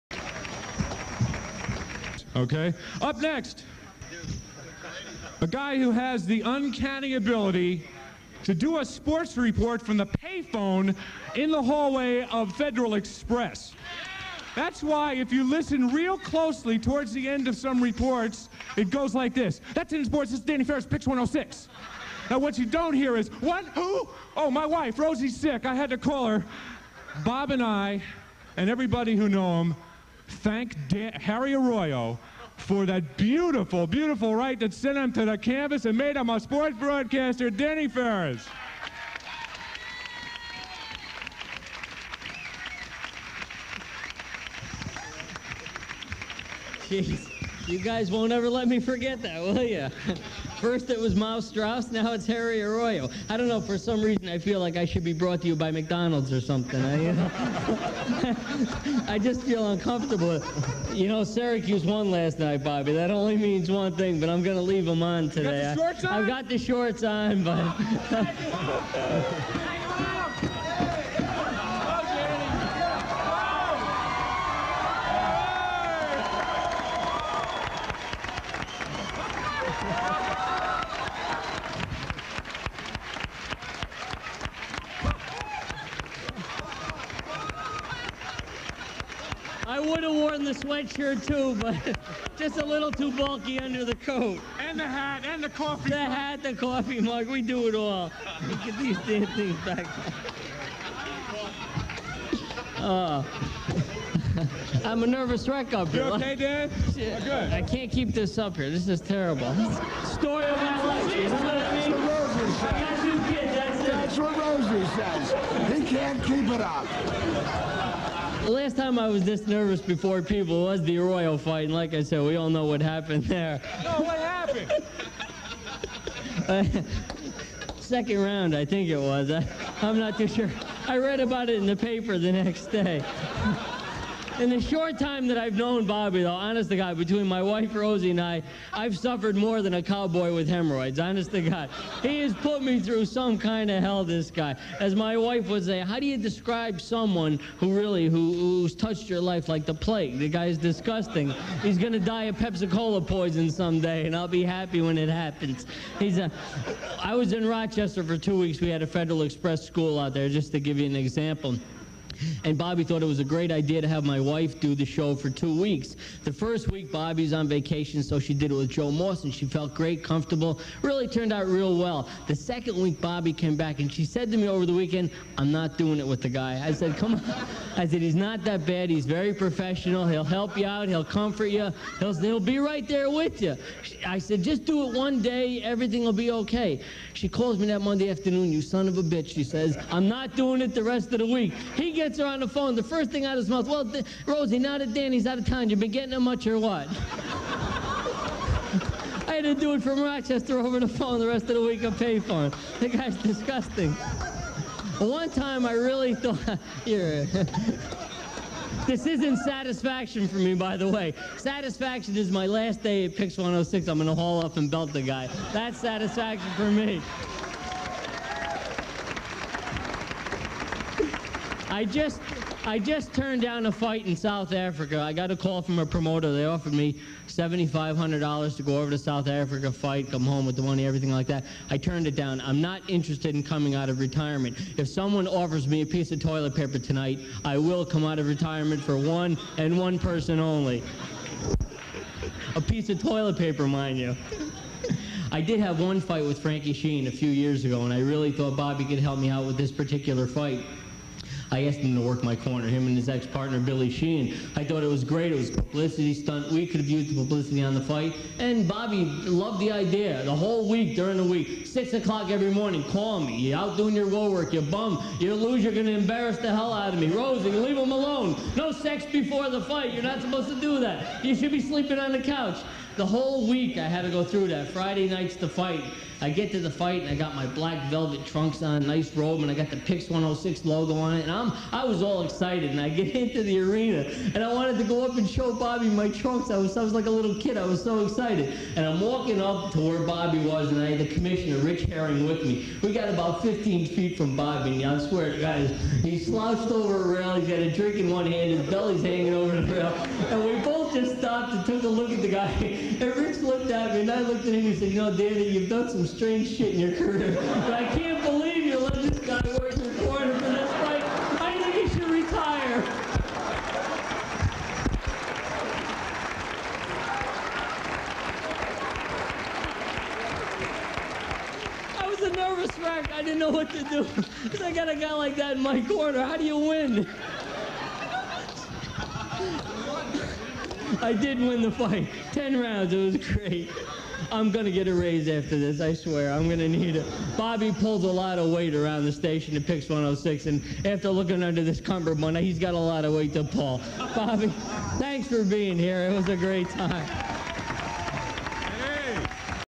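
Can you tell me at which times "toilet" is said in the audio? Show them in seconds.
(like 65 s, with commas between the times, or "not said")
236 s, 243 s.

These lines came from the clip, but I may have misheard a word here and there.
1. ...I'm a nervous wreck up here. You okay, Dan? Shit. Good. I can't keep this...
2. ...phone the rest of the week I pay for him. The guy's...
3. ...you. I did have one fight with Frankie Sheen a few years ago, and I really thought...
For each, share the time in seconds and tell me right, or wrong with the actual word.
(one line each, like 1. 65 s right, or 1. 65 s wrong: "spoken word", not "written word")
1. 104 s right
2. 200 s right
3. 243 s right.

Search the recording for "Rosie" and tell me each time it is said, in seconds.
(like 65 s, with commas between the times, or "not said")
24 s, 114 s, 137 s, 194 s, 267 s.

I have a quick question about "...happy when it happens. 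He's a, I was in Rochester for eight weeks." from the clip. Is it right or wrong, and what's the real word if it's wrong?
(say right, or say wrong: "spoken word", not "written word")
wrong: "two", not "eight".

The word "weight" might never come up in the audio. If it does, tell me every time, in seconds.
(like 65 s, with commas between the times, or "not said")
338 s, 343 s.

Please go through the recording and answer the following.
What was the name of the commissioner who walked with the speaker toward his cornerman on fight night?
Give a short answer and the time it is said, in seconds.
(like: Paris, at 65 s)
Rich Herring, at 291 s.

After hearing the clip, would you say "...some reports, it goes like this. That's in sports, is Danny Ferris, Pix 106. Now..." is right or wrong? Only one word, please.
right.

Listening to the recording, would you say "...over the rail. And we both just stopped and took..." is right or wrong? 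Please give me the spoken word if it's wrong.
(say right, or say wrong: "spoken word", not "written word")
right.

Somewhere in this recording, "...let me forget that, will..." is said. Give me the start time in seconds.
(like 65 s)
48 s.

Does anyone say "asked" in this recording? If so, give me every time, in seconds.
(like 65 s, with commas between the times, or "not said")
251 s.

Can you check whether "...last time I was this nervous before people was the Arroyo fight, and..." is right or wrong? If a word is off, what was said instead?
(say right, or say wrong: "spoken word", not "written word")
right.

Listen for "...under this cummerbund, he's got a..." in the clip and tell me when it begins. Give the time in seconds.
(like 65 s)
341 s.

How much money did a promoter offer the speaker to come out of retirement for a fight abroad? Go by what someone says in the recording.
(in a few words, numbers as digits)
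$7,500.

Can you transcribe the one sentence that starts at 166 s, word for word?
The first week, Bobby's on vacation, so she did it with Joe Moss, and she felt great, comfortable.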